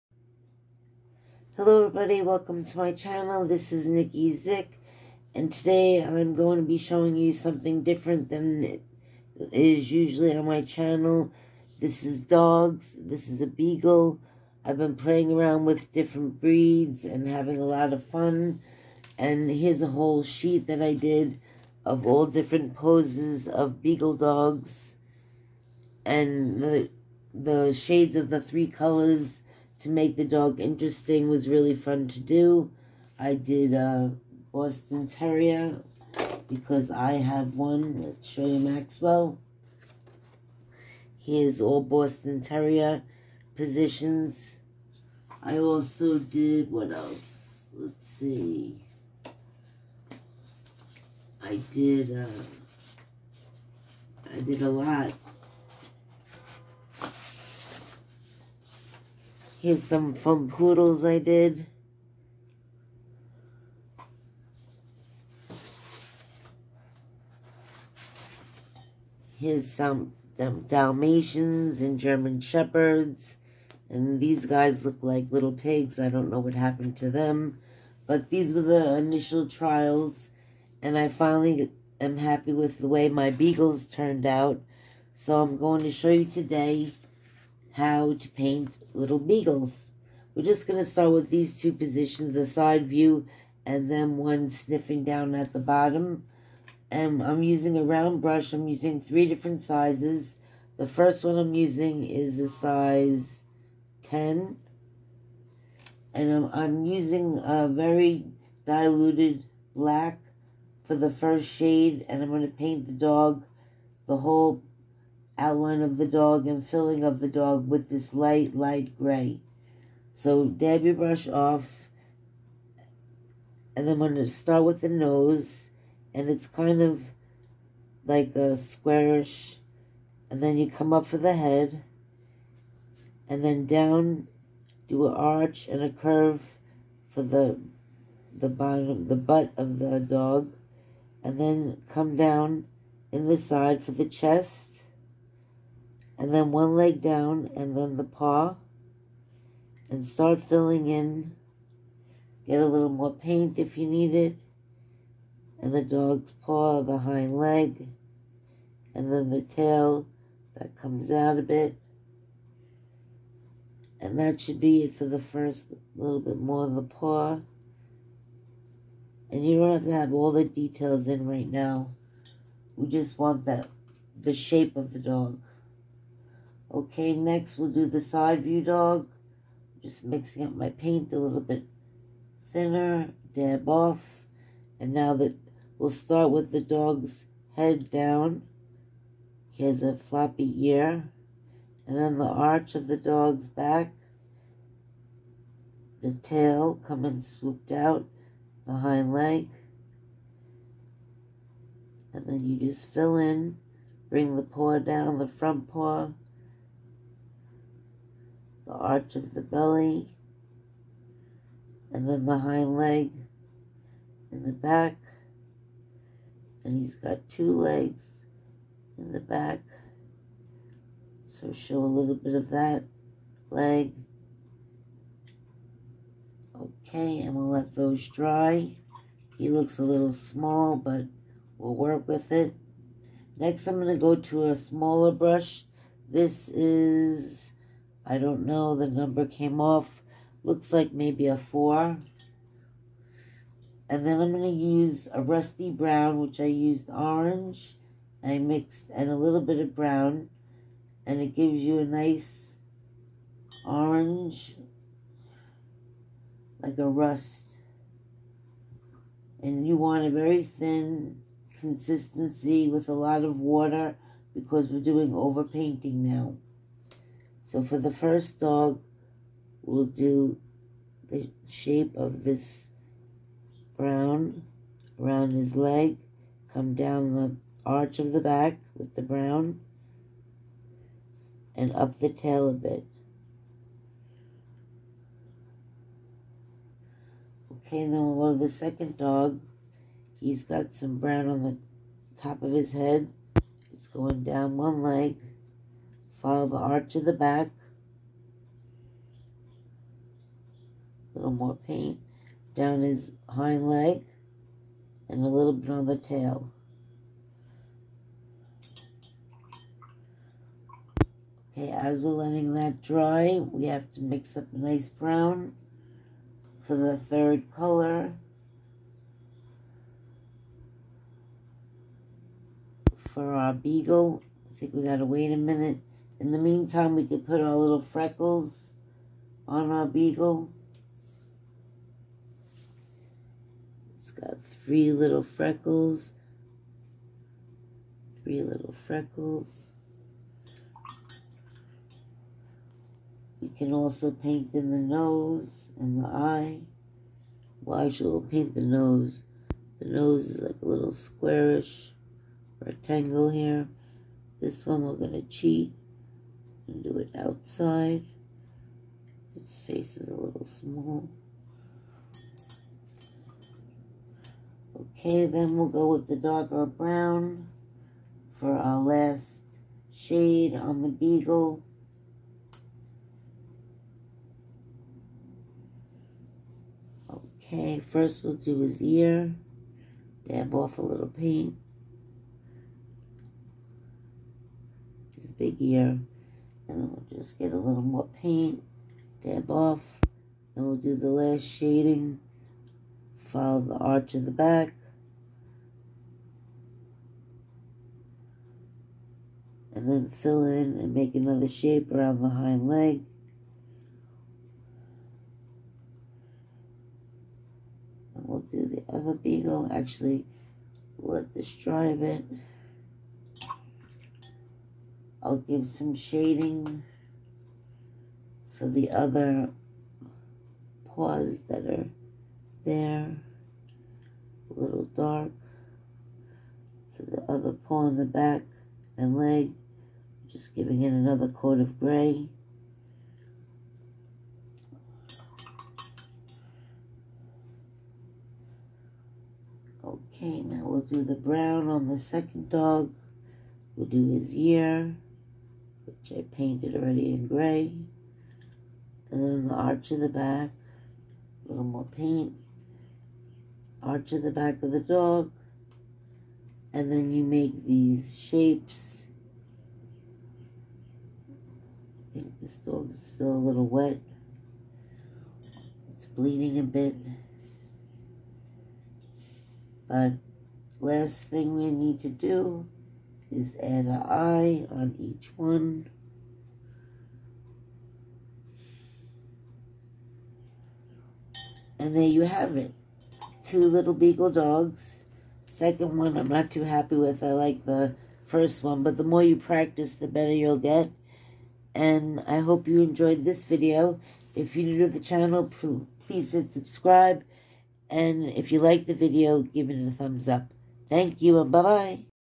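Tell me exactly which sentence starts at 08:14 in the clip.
If you're new to the channel, please hit subscribe.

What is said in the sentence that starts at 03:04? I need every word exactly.
And now that we'll start with the dog's head down.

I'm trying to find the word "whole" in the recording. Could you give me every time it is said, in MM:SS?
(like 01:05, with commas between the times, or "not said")
00:19, 01:54.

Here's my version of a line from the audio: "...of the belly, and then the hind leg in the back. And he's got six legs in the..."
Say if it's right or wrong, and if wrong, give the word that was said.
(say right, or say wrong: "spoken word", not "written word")
wrong: "two", not "six".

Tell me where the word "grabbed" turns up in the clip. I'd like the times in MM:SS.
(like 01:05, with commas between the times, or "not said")
not said.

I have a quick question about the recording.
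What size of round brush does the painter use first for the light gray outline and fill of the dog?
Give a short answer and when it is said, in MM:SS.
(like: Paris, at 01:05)
10, at 01:42.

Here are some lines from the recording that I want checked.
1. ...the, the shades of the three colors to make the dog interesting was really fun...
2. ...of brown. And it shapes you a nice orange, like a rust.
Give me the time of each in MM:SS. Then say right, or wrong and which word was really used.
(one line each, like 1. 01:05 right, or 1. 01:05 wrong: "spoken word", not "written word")
1. 00:26 right
2. 04:09 wrong: "gives", not "shapes".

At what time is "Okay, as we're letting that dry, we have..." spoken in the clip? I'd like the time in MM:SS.
05:11.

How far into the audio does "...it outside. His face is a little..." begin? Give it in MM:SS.
05:56.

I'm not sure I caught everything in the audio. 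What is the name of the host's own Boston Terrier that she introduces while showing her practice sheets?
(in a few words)
Maxwell.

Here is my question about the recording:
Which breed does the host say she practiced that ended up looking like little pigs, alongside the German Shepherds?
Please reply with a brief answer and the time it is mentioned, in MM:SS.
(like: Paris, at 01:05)
Dalmatians, at 01:10.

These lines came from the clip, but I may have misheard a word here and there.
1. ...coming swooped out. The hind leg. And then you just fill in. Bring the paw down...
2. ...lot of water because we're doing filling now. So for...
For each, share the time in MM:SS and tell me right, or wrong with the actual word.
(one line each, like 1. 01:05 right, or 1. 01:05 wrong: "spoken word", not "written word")
1. 03:16 right
2. 04:22 wrong: "overpainting", not "filling".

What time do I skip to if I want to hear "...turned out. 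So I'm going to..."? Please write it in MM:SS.
01:23.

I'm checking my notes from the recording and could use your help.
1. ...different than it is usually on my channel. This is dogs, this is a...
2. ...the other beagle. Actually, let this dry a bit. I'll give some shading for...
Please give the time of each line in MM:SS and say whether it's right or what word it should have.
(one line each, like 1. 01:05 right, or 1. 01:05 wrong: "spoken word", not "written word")
1. 00:07 right
2. 06:48 right.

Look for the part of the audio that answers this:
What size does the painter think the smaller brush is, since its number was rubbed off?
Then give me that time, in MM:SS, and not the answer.
04:01.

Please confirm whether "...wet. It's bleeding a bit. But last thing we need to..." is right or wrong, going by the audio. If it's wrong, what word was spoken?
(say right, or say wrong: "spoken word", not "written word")
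right.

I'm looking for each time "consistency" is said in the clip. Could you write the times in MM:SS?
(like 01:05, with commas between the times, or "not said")
04:21.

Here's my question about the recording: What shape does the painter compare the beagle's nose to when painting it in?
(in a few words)
squarish rectangle.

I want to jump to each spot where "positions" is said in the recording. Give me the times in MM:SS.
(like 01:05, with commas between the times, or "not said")
00:43, 01:31.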